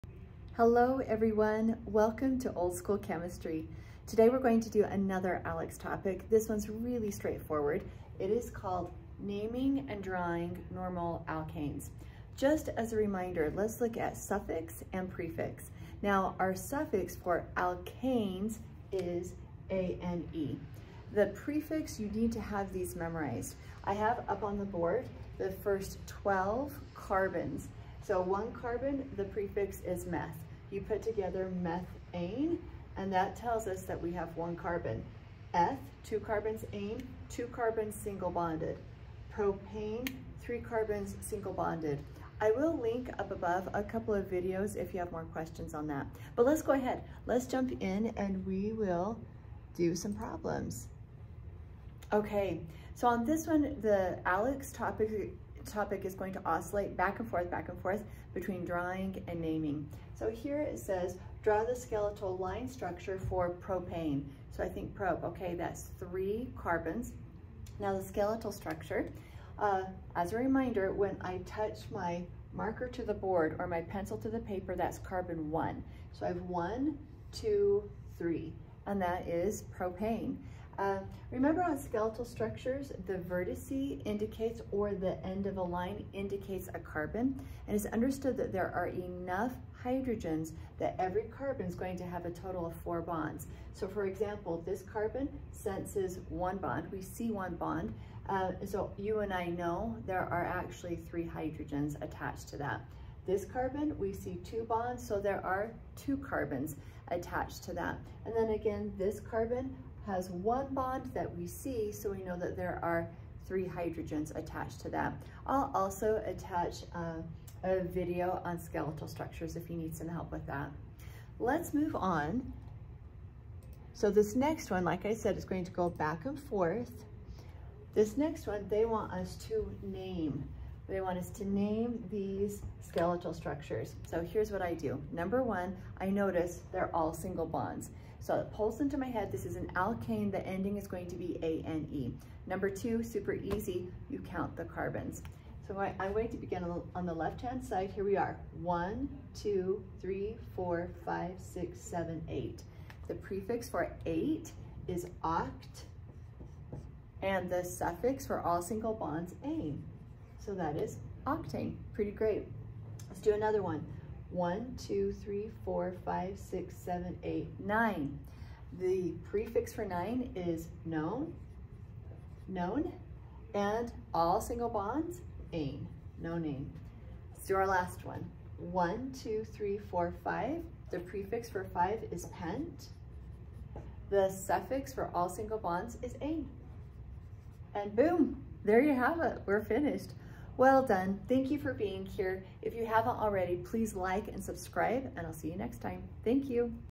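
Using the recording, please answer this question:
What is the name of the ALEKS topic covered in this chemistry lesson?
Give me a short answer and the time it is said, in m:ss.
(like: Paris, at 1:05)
Naming and Drawing Normal Alkanes, at 0:09.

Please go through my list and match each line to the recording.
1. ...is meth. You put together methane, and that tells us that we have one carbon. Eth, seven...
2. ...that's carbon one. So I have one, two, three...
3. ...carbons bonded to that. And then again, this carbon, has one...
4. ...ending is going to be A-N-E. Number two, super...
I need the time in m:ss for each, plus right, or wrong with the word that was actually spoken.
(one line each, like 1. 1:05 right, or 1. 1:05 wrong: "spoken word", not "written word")
1. 0:29 wrong: "two", not "seven"
2. 1:14 right
3. 1:46 wrong: "attached", not "bonded"
4. 2:20 right.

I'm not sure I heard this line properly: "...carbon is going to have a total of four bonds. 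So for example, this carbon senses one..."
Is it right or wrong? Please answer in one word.
right.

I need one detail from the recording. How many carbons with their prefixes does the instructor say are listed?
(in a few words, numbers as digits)
12.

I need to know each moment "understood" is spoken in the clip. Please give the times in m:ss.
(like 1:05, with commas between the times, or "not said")
1:27.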